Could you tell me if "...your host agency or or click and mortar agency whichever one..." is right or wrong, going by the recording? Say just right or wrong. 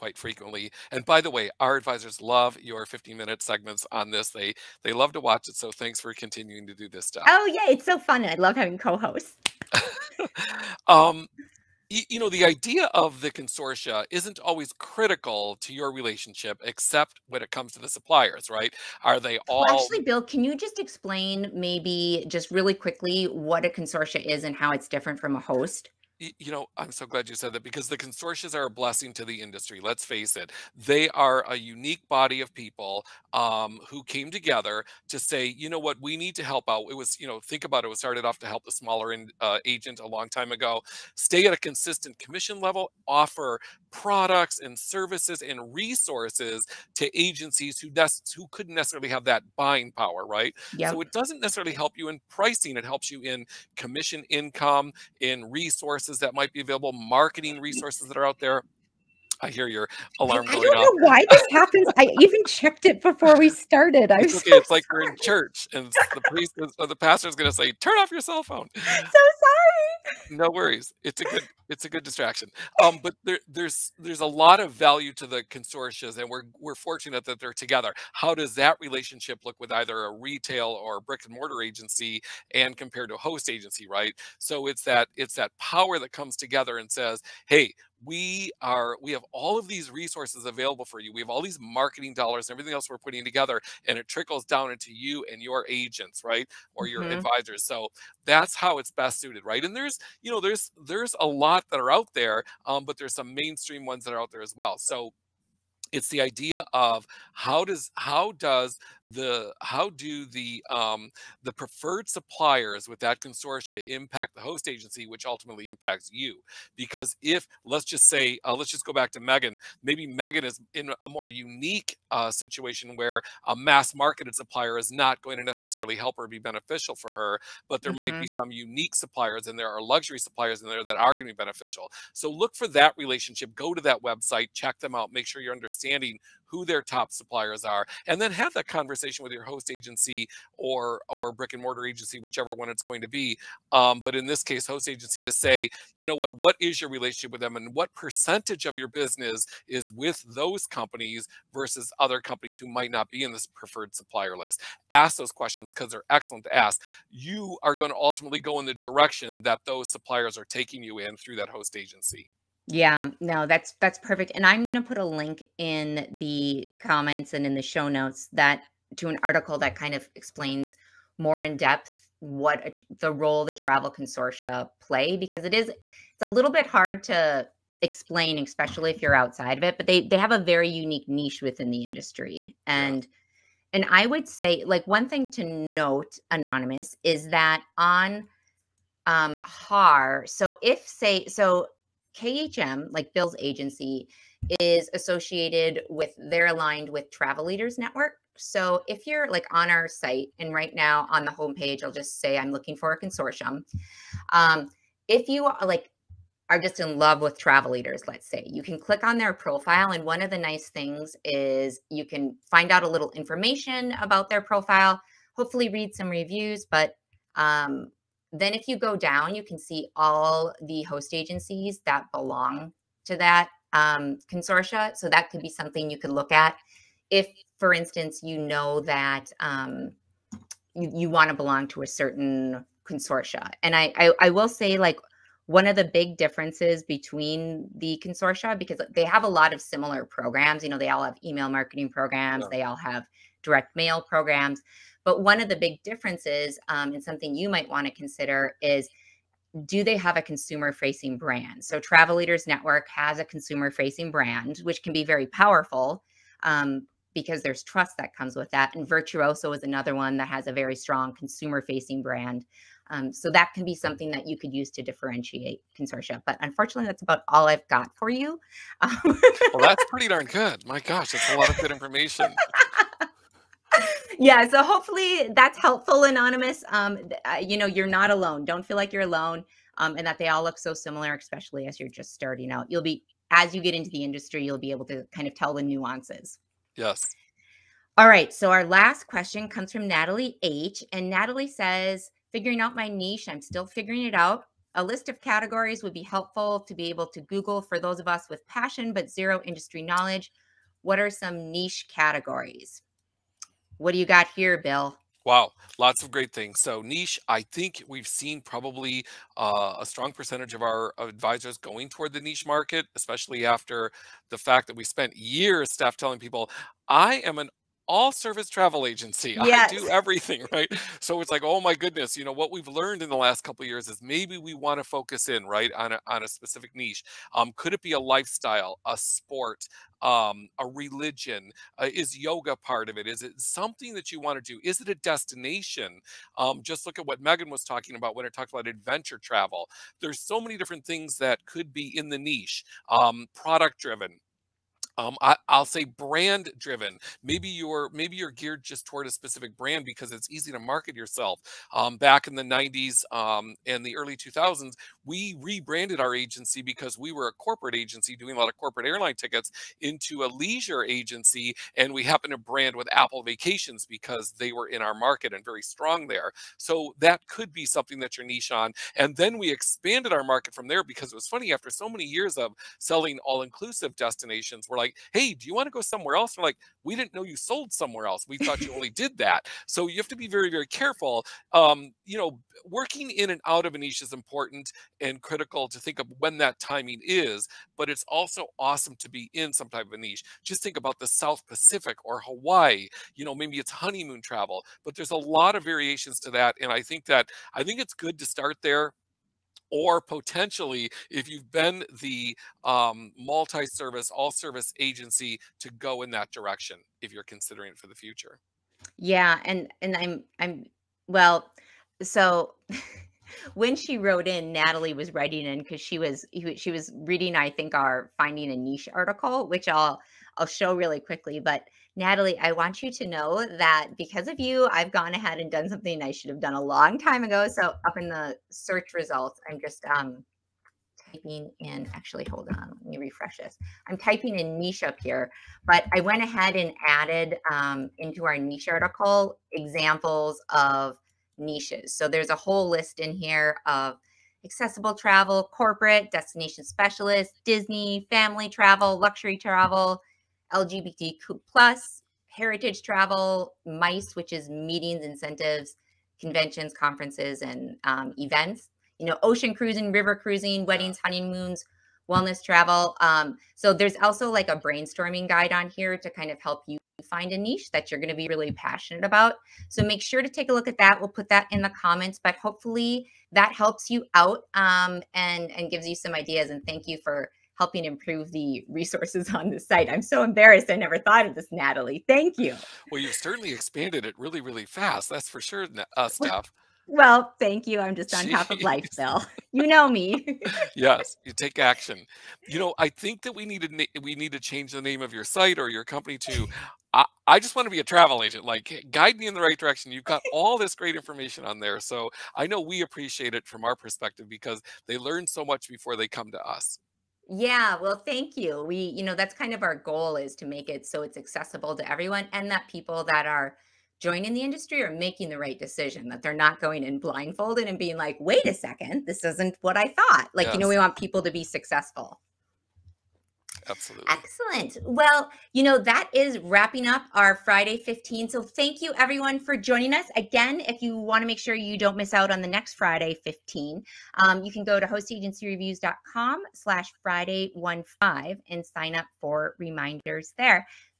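wrong.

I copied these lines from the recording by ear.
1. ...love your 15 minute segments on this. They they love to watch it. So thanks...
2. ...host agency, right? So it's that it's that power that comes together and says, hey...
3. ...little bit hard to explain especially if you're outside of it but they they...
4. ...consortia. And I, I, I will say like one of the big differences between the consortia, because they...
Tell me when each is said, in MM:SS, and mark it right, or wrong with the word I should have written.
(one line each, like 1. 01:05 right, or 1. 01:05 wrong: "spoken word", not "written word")
1. 00:02 right
2. 01:23 right
3. 02:56 right
4. 03:52 right.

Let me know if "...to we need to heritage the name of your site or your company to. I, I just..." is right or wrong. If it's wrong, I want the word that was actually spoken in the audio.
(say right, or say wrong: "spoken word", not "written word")
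wrong: "change", not "heritage".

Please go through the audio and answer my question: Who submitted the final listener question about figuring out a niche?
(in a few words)
Natalie H.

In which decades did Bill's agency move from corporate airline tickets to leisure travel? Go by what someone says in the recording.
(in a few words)
The 90s and early 2000s.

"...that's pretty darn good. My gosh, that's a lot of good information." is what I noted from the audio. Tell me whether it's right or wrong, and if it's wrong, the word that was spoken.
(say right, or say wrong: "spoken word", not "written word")
right.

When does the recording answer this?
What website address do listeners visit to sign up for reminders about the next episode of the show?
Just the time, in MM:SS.
08:54.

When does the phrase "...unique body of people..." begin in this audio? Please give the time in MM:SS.
00:31.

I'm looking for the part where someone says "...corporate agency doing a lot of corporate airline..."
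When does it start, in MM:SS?
05:57.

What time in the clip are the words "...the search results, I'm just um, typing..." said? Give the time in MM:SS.
07:08.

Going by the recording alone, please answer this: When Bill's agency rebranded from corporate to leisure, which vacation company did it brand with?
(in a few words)
Apple Vacations.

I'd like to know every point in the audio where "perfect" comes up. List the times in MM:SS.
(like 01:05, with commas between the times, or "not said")
02:43.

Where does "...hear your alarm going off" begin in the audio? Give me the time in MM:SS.
00:59.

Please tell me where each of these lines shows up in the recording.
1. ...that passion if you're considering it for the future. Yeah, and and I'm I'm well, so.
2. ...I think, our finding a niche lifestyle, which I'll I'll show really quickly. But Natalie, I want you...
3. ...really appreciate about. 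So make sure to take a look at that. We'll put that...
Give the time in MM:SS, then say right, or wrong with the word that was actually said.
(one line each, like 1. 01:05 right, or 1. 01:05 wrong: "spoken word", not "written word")
1. 06:46 wrong: "direction", not "passion"
2. 06:57 wrong: "article", not "lifestyle"
3. 07:48 wrong: "passionate", not "appreciate".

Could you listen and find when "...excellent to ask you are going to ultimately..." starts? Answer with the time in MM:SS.
02:36.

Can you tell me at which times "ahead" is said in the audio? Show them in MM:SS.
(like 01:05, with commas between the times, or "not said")
07:05, 07:16.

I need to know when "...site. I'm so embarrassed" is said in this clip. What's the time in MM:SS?
07:59.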